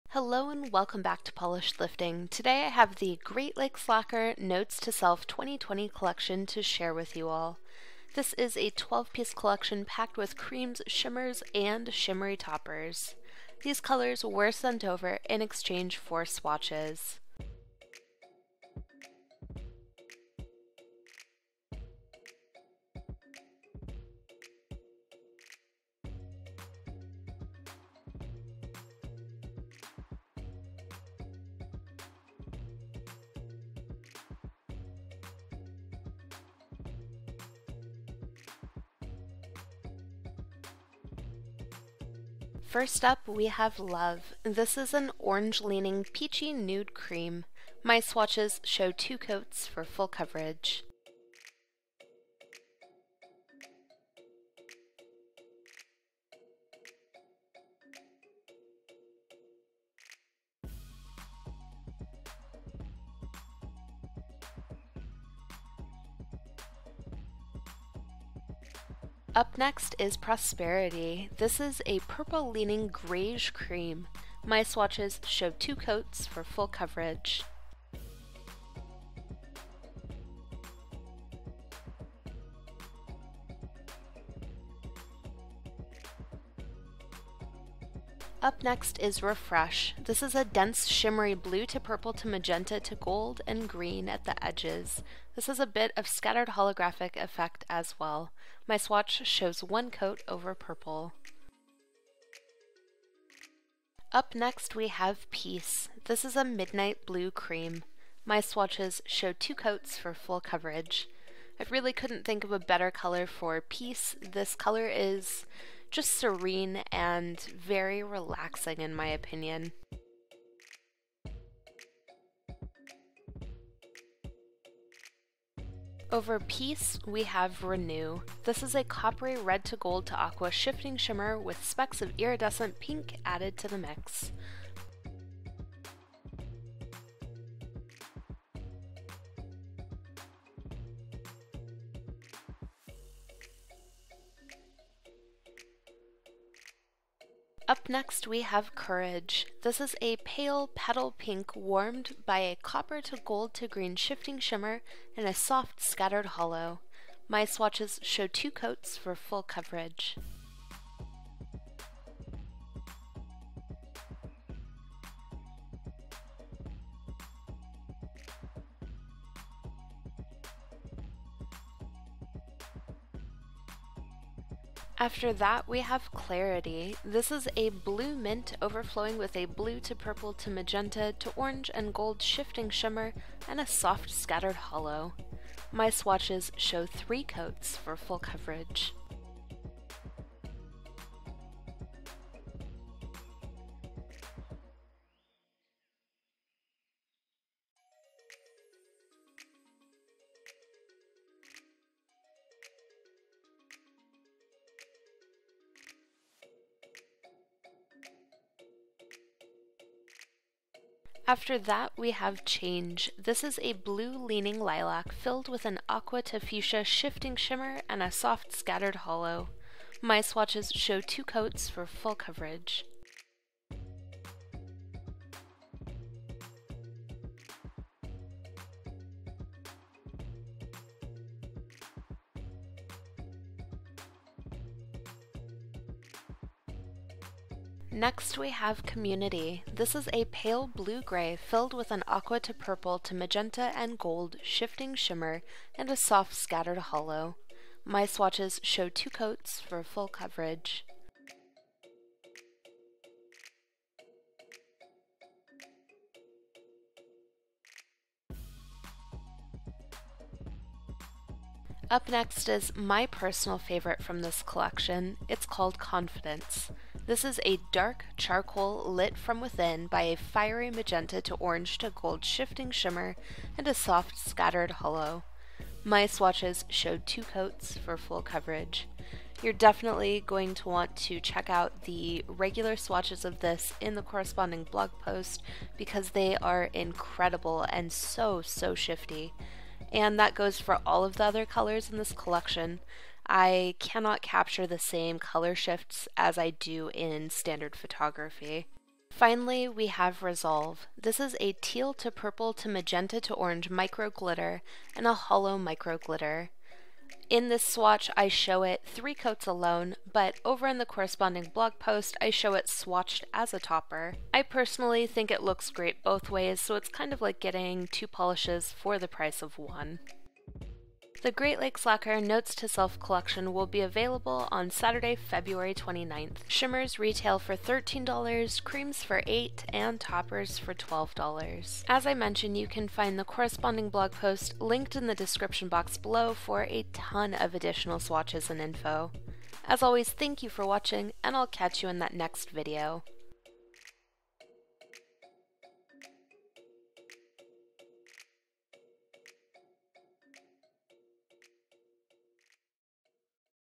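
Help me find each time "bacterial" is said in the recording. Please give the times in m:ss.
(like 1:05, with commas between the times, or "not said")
not said.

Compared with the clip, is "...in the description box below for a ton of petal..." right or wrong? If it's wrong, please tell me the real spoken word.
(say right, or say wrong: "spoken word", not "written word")
wrong: "additional", not "petal".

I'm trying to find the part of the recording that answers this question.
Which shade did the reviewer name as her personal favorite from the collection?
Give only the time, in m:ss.
4:25.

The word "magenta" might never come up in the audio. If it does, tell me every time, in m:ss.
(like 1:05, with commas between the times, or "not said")
1:32, 3:00, 4:03, 4:30, 5:02.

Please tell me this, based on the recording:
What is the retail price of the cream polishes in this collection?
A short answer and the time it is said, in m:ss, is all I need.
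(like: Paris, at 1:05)
$8, at 5:29.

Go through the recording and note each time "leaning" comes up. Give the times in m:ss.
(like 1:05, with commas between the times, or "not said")
0:45, 1:12, 3:33.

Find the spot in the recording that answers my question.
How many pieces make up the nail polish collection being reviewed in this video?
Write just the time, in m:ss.
0:08.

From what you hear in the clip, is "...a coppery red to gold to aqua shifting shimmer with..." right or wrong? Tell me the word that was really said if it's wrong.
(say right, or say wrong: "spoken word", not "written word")
right.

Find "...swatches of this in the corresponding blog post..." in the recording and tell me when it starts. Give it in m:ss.
4:42.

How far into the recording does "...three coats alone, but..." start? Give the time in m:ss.
5:08.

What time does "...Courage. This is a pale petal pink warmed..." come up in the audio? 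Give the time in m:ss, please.
2:28.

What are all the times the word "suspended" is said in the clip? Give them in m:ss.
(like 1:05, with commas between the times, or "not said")
not said.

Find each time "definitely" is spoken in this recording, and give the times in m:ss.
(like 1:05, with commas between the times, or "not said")
4:39.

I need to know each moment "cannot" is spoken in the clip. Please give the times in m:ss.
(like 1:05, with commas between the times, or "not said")
4:53.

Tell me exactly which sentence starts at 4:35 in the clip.
My swatches showed two coats for full coverage.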